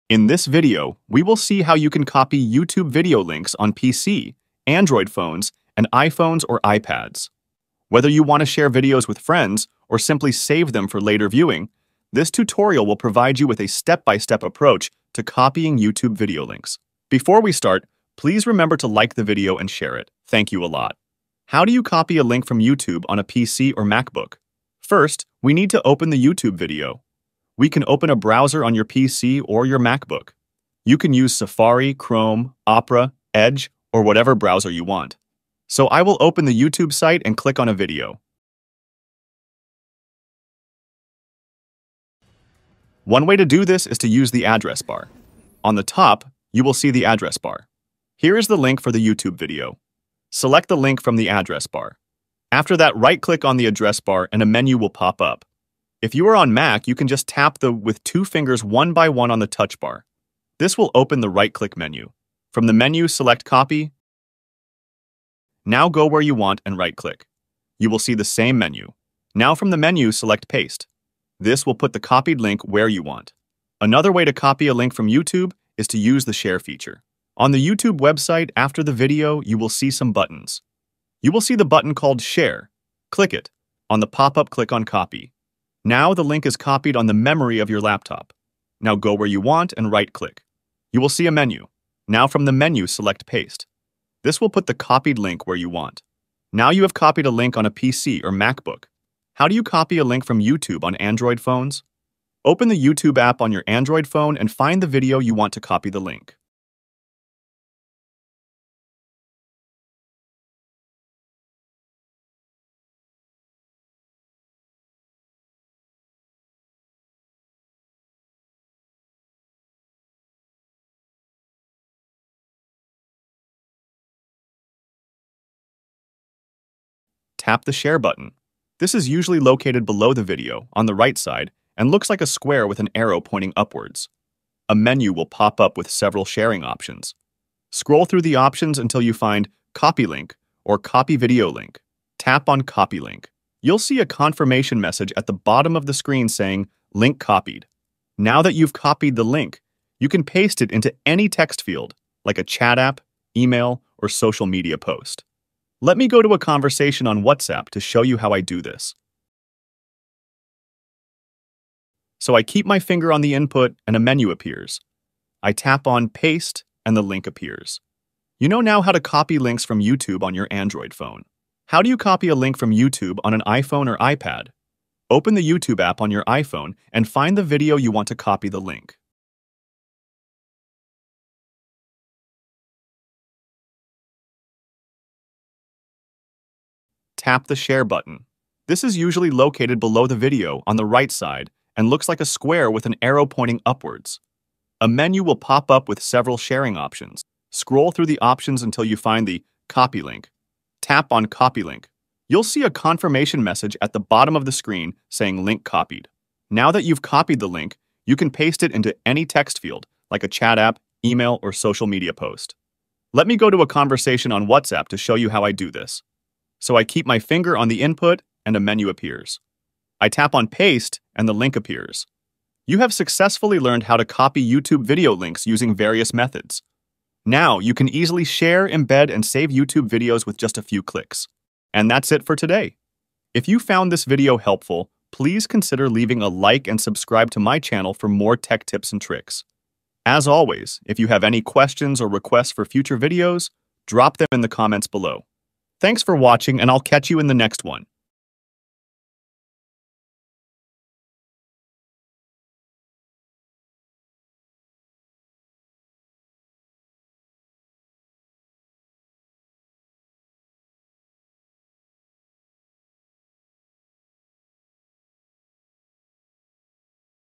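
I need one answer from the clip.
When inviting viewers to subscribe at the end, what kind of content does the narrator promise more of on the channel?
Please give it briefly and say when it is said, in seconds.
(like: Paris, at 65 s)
tech tips and tricks, at 238 s.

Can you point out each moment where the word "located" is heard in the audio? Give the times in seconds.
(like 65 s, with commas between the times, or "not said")
129 s, 189 s.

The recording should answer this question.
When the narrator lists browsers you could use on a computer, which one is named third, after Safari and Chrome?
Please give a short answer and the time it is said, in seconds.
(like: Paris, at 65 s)
Opera, at 32 s.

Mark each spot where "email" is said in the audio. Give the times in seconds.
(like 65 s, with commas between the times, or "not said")
153 s, 211 s.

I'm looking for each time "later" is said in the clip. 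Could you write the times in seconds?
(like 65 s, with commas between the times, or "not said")
10 s.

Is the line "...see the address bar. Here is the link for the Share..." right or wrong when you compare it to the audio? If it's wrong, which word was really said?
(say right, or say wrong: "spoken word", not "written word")
wrong: "YouTube", not "Share".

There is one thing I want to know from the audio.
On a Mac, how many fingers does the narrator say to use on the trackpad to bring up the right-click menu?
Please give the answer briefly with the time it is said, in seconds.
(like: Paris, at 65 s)
2, at 58 s.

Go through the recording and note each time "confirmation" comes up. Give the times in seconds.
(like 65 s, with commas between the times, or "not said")
144 s, 202 s.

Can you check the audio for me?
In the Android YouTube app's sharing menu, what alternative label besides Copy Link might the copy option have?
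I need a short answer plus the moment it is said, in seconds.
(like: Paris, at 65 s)
Copy Video Link, at 140 s.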